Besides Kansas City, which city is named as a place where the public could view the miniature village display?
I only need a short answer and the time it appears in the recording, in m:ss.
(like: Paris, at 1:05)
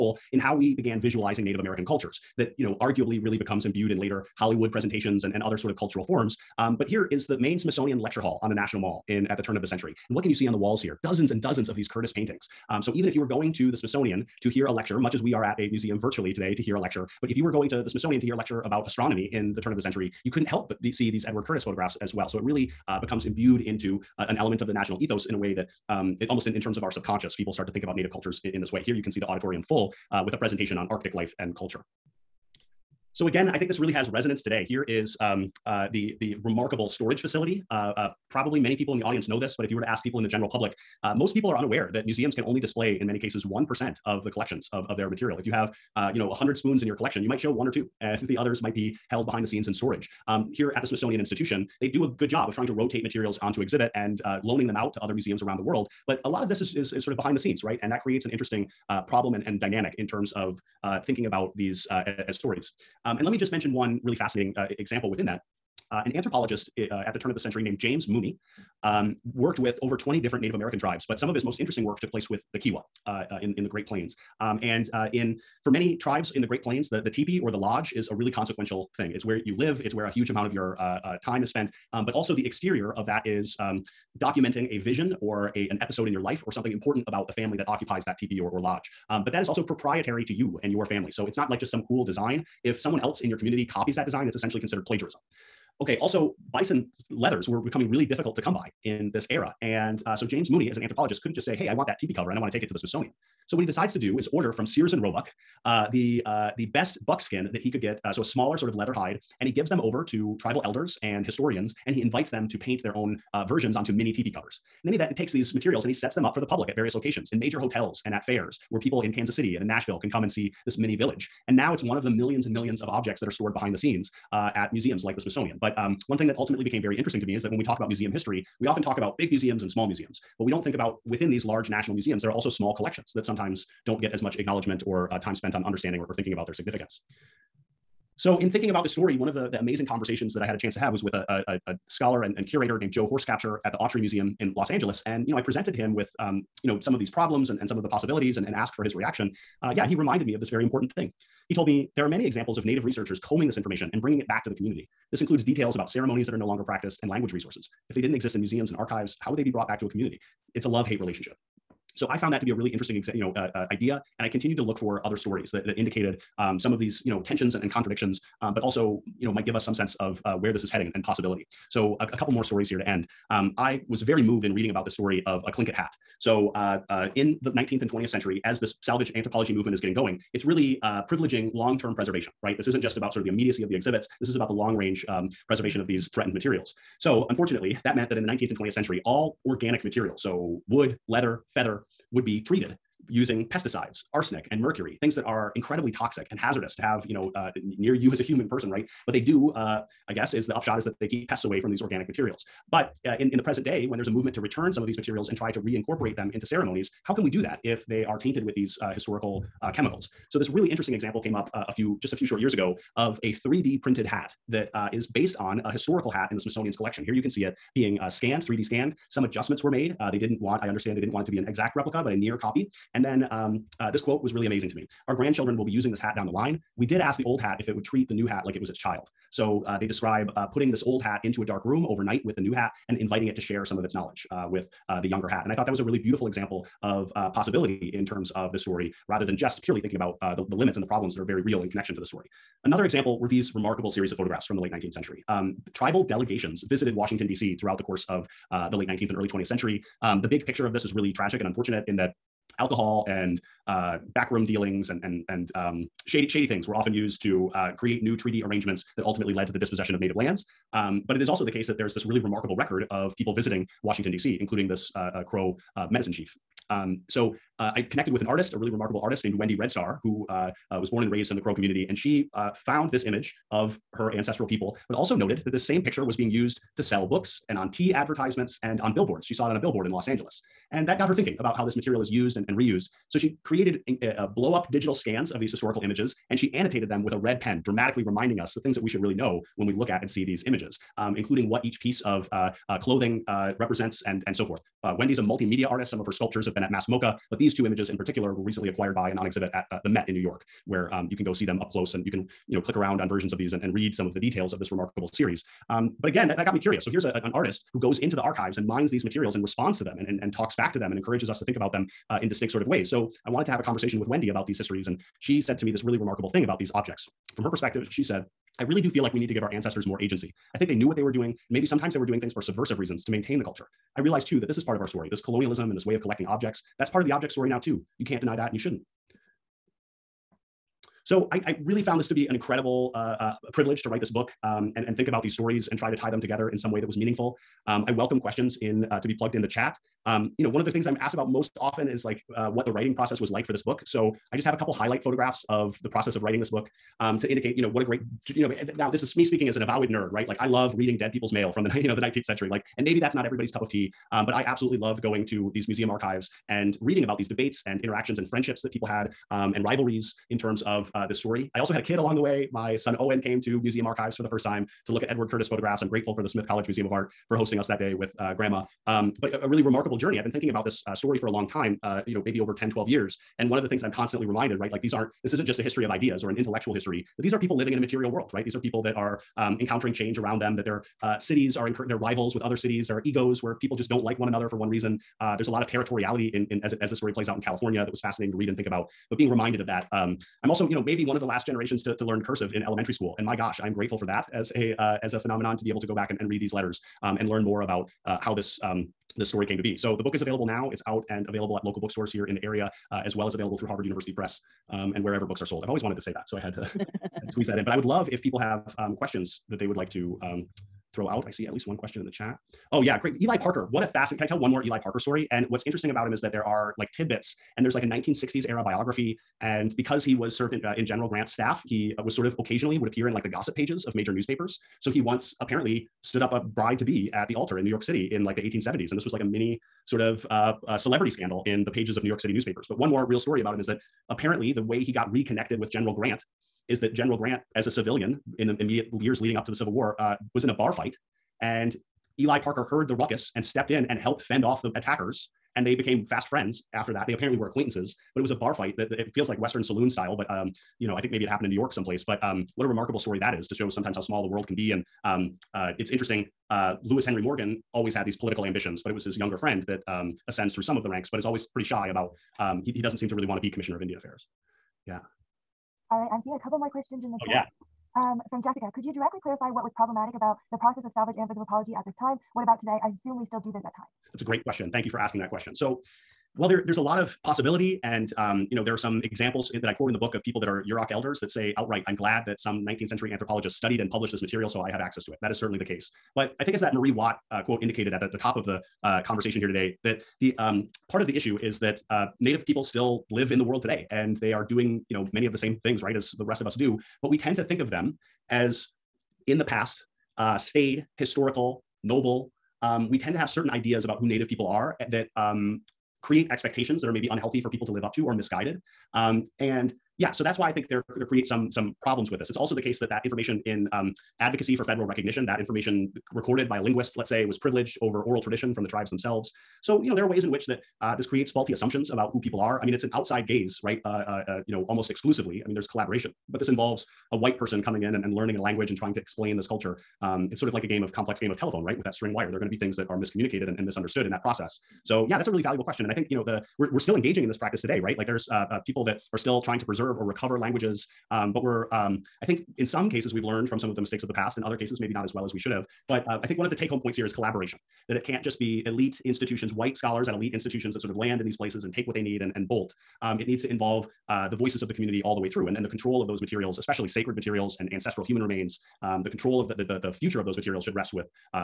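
Nashville, at 1:59.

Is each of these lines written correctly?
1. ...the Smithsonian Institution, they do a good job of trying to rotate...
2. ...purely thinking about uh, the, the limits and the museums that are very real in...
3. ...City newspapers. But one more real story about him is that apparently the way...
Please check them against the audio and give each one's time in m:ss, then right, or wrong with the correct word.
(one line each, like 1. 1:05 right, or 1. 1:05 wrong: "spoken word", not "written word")
1. 0:50 right
2. 3:59 wrong: "problems", not "museums"
3. 7:12 right.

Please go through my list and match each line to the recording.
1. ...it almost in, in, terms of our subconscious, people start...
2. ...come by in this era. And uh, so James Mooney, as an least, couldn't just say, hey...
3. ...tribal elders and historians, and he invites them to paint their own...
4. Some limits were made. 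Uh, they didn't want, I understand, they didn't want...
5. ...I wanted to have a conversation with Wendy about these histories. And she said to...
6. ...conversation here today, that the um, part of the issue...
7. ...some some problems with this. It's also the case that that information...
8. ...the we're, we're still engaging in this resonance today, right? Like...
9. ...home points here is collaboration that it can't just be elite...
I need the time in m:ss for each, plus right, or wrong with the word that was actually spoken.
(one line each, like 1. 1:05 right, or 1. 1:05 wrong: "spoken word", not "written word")
1. 0:26 right
2. 1:38 wrong: "anthropologist", not "least"
3. 1:50 right
4. 3:39 wrong: "adjustments", not "limits"
5. 5:13 right
6. 8:09 right
7. 8:31 right
8. 8:56 wrong: "practice", not "resonance"
9. 9:06 right.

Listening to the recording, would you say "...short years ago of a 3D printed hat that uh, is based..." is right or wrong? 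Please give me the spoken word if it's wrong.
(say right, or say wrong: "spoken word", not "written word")
right.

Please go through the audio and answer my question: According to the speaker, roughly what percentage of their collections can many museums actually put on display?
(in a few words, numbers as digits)
1%.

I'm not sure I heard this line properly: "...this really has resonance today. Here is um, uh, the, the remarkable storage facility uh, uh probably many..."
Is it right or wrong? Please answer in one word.
right.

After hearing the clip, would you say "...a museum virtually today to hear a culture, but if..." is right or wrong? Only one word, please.
wrong.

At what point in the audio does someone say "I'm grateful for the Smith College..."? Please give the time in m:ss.
6:05.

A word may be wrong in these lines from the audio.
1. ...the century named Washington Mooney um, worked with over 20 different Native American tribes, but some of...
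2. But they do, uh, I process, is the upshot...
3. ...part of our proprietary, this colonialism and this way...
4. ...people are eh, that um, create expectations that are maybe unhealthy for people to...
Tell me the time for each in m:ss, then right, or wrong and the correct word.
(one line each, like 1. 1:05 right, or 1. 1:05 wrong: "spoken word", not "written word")
1. 1:07 wrong: "James", not "Washington"
2. 3:19 wrong: "guess", not "process"
3. 5:24 wrong: "story", not "proprietary"
4. 8:24 right.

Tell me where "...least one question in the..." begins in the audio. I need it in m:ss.
6:51.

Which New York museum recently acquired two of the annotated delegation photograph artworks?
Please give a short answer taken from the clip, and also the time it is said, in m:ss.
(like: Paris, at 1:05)
the Met, at 4:59.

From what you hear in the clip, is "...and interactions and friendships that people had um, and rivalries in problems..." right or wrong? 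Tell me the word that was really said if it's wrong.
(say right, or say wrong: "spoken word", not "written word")
wrong: "terms", not "problems".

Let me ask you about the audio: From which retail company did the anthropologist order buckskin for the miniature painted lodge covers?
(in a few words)
Sears and Roebuck.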